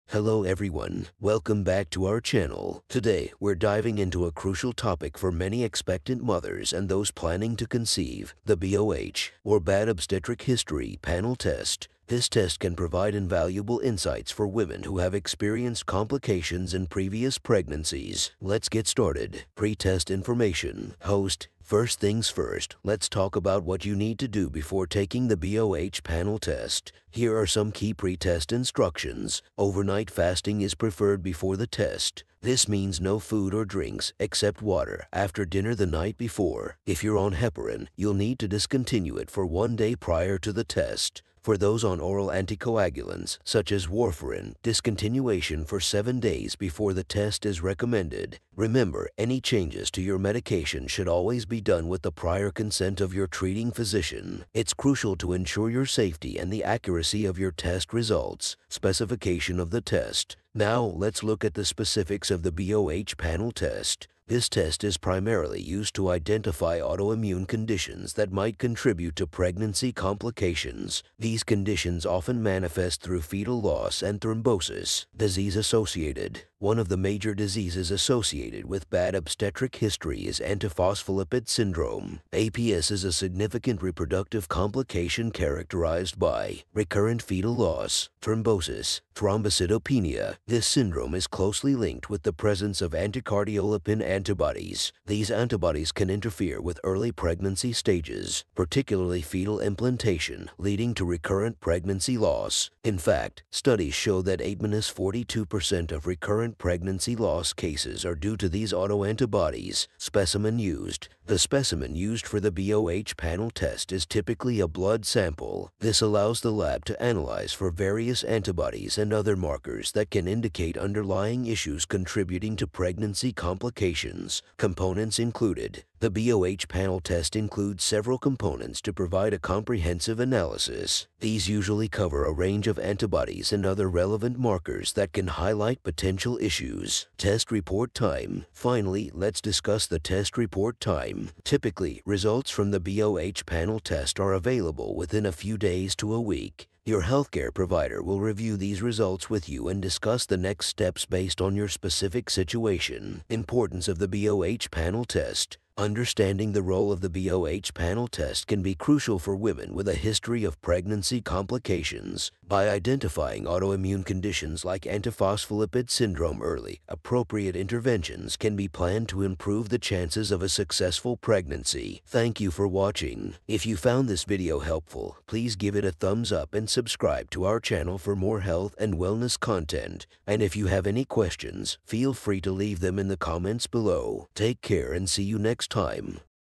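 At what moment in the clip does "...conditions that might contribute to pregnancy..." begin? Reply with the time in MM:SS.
01:07.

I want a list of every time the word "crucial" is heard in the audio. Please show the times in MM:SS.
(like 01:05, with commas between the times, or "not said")
00:04, 00:54, 02:38.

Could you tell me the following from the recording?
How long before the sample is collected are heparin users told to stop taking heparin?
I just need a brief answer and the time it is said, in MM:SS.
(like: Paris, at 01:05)
1 day, at 00:39.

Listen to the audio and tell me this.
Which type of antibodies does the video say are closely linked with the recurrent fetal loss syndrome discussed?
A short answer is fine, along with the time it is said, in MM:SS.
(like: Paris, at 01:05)
anticardiolipin antibodies, at 01:32.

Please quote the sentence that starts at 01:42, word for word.
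In fact, studies show that 8 42% of recurrent pregnancy loss cases are due to these autoantibodies.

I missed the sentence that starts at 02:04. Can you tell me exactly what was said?
Components included the BOH panel test includes several components to provide a comprehensive analysis.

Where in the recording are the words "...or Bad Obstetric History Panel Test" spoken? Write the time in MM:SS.
00:09.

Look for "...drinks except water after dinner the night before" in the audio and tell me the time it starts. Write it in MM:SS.
00:33.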